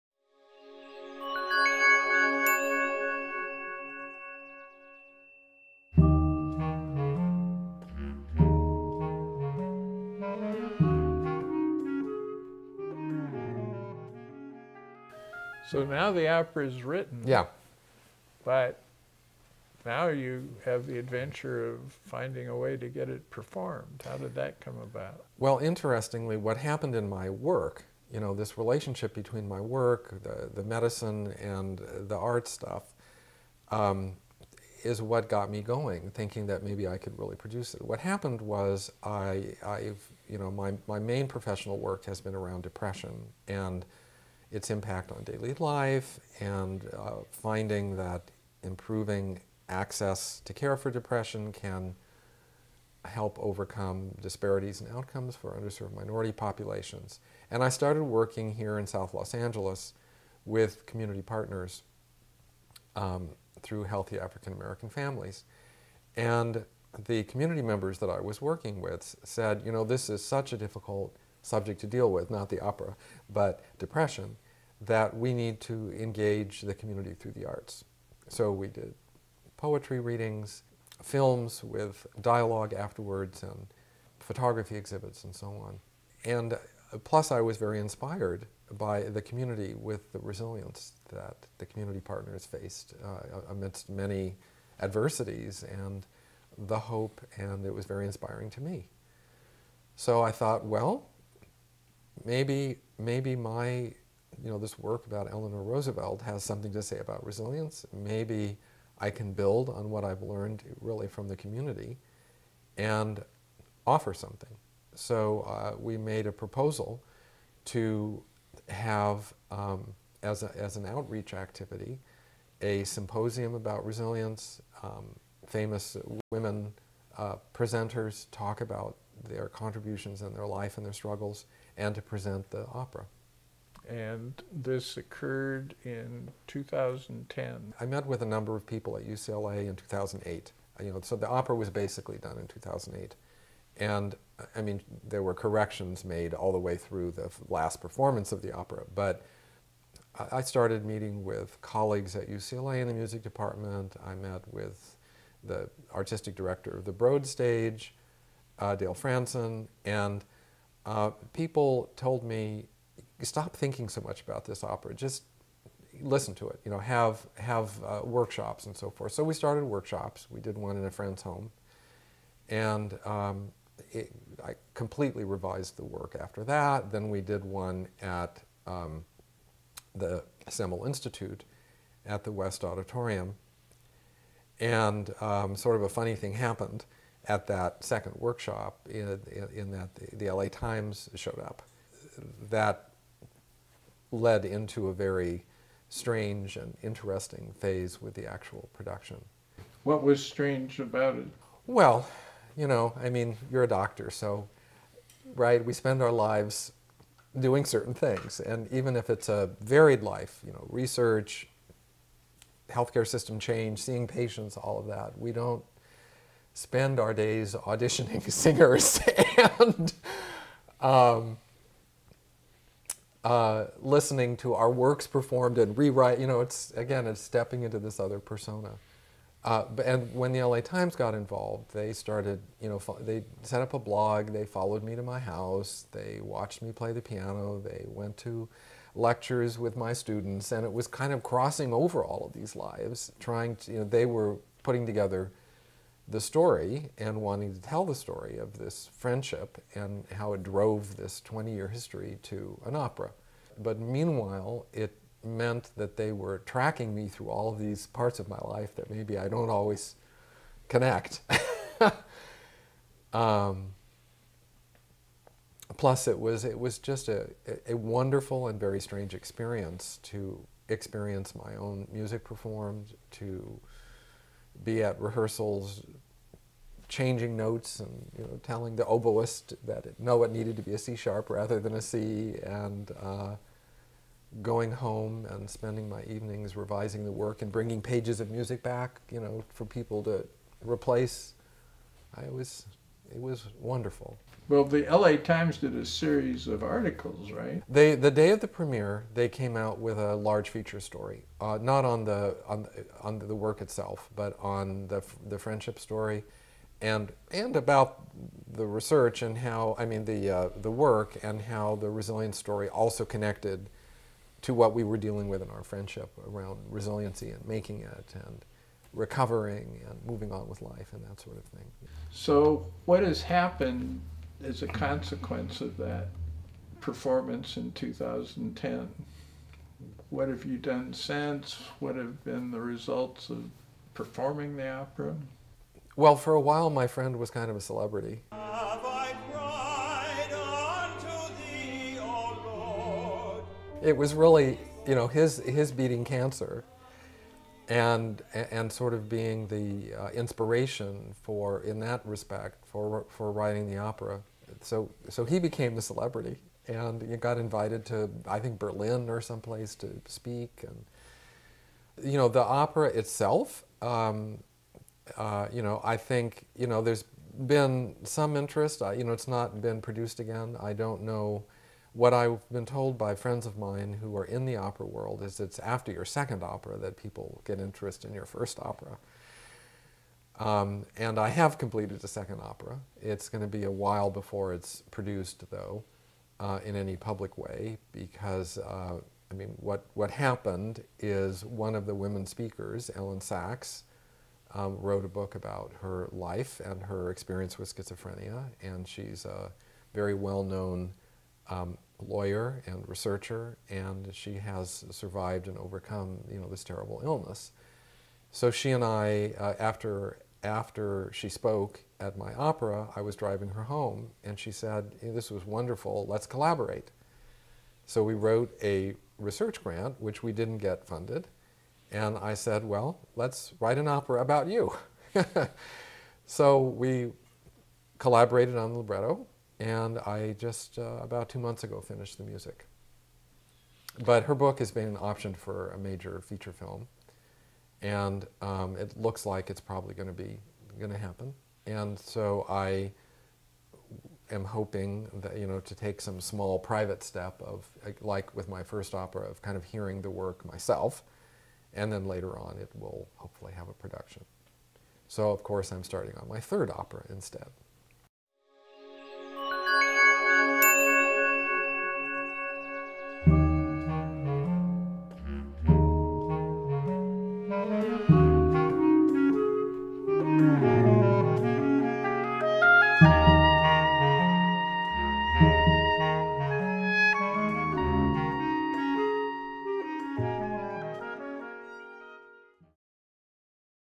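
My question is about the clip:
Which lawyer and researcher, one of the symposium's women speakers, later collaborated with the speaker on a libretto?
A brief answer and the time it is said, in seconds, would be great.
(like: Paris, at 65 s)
Elyn Saks, at 392 s.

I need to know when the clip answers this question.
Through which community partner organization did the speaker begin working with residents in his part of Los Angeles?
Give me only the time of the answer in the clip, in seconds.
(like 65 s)
63 s.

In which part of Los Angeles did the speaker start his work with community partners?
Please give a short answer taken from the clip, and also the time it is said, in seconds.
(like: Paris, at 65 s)
South Los Angeles, at 58 s.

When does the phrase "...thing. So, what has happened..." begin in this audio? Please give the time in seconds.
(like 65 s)
321 s.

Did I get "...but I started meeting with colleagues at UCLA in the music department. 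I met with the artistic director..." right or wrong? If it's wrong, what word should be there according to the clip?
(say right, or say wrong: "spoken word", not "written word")
right.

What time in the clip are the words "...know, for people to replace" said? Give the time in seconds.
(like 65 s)
289 s.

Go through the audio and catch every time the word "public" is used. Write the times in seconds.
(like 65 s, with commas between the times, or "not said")
386 s.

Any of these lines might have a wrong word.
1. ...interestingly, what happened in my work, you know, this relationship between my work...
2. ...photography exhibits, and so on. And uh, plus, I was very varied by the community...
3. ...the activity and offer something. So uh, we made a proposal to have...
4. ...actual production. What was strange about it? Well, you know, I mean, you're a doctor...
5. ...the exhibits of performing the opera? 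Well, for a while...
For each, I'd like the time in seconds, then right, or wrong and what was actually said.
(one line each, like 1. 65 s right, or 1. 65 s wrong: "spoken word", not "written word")
1. 25 s right
2. 84 s wrong: "inspired", not "varied"
3. 111 s wrong: "community", not "activity"
4. 198 s right
5. 332 s wrong: "results", not "exhibits".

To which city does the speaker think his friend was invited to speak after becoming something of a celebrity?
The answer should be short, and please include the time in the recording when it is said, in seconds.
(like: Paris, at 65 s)
Berlin, at 358 s.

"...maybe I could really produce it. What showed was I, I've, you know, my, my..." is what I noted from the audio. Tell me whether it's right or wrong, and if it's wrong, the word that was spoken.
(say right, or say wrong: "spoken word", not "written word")
wrong: "happened", not "showed".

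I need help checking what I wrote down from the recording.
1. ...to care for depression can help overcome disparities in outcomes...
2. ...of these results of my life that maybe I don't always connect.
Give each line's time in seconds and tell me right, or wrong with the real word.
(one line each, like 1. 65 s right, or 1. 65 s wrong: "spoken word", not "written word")
1. 50 s right
2. 257 s wrong: "parts", not "results".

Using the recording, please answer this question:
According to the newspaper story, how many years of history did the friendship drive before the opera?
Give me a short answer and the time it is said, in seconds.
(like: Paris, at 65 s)
20 years, at 251 s.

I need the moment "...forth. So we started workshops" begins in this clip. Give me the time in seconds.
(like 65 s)
168 s.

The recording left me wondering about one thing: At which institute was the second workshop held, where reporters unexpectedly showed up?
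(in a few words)
Semel Institute.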